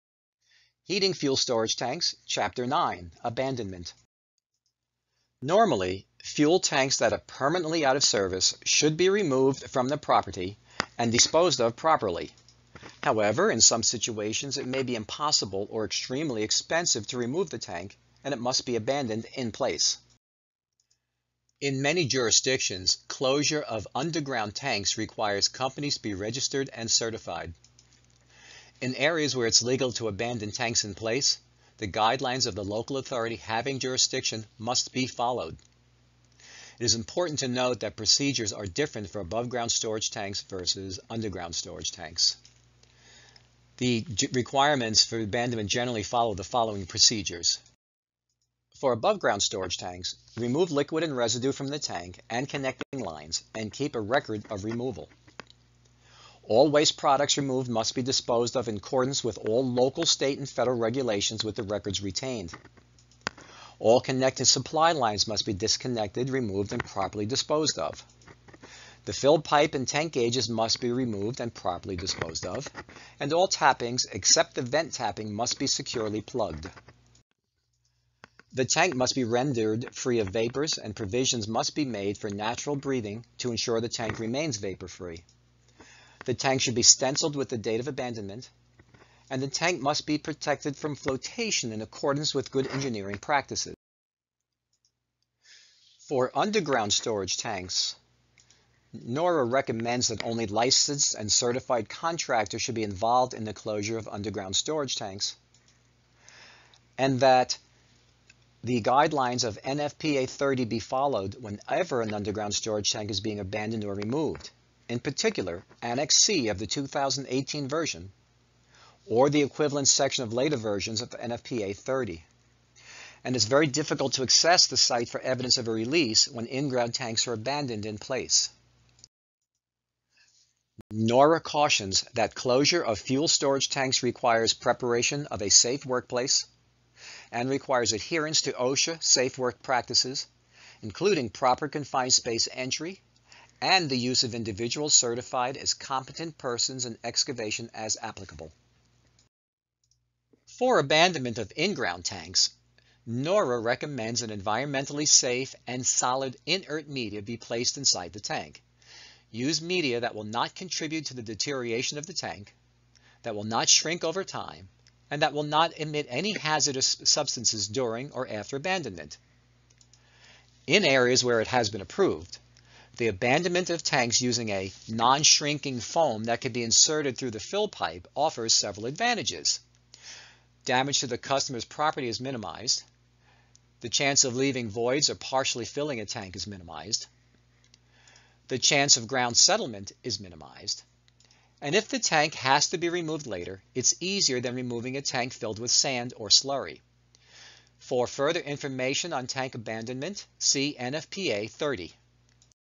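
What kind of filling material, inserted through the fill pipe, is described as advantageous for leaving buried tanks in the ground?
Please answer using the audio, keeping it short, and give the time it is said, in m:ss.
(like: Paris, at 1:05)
Non-shrinking foam, at 2:54.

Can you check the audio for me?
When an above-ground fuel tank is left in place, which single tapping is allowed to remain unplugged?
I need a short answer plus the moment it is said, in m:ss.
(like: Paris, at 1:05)
Vent tapping, at 1:14.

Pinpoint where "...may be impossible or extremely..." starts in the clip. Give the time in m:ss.
0:14.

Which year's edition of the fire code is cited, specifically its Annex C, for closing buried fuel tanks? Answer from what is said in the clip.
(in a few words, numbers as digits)
2018.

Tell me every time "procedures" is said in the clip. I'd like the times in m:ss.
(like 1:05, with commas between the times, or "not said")
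0:37, 0:46.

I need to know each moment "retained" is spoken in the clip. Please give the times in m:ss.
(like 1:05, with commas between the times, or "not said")
1:02.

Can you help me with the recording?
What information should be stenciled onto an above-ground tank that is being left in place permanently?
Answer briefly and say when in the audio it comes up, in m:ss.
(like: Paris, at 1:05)
Date of abandonment, at 1:27.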